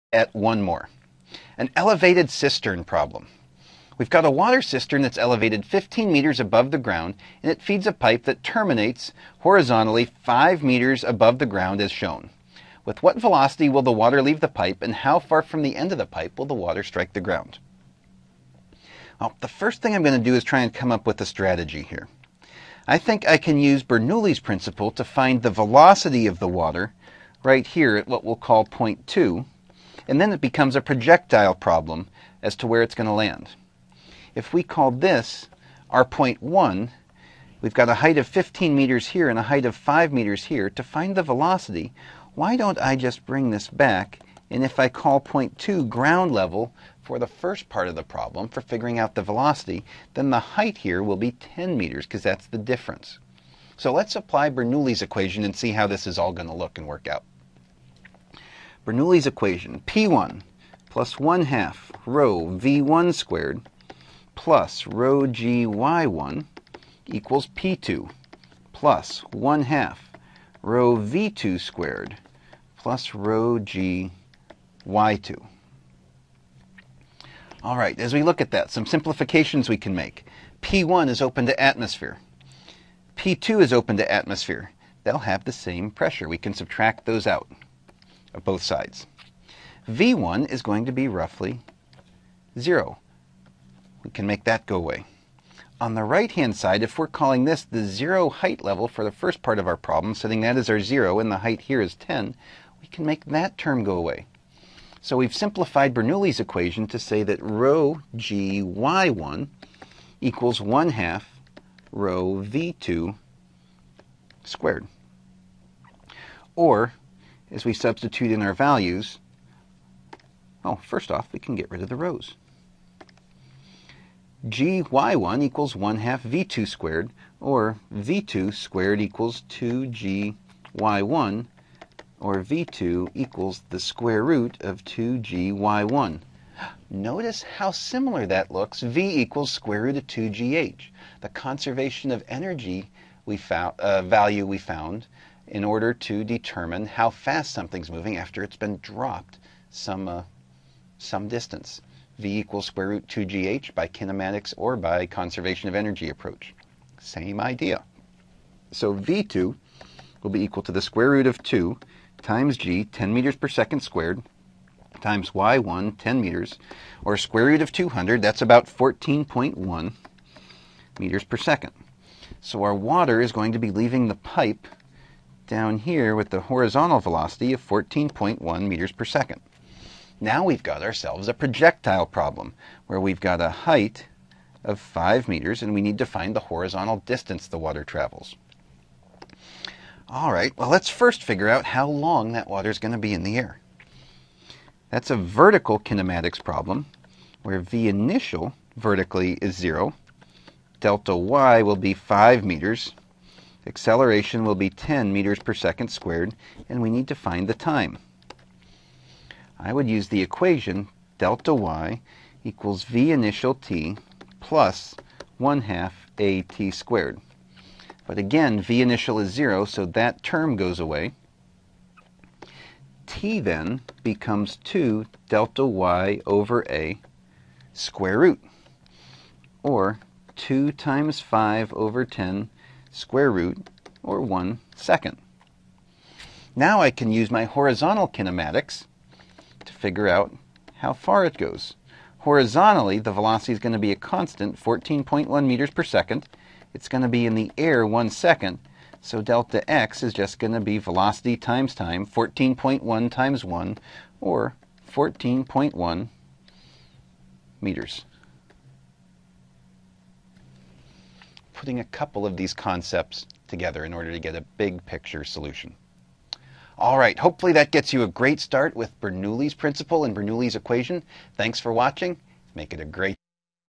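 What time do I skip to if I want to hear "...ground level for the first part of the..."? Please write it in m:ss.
0:45.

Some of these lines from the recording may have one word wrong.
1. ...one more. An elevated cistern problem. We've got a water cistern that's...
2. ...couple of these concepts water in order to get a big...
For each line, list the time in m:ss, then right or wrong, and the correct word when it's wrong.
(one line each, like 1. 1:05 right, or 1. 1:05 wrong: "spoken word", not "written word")
1. 0:00 right
2. 4:21 wrong: "together", not "water".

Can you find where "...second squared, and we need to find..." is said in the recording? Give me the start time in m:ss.
3:25.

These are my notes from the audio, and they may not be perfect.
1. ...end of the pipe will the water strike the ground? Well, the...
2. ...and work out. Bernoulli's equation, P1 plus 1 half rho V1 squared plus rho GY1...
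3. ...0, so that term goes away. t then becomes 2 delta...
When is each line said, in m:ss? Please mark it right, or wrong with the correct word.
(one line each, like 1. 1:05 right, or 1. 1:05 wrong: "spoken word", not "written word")
1. 0:15 right
2. 0:56 right
3. 3:39 right.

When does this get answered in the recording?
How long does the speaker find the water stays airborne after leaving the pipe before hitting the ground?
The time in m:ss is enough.
3:54.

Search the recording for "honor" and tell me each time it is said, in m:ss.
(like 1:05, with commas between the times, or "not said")
not said.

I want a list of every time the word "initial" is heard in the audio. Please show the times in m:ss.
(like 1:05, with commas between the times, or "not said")
3:17, 3:33, 3:38.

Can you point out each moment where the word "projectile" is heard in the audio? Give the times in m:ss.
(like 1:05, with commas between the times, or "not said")
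0:30, 3:01.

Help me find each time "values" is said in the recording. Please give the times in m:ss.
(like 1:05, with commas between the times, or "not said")
1:58, 2:24.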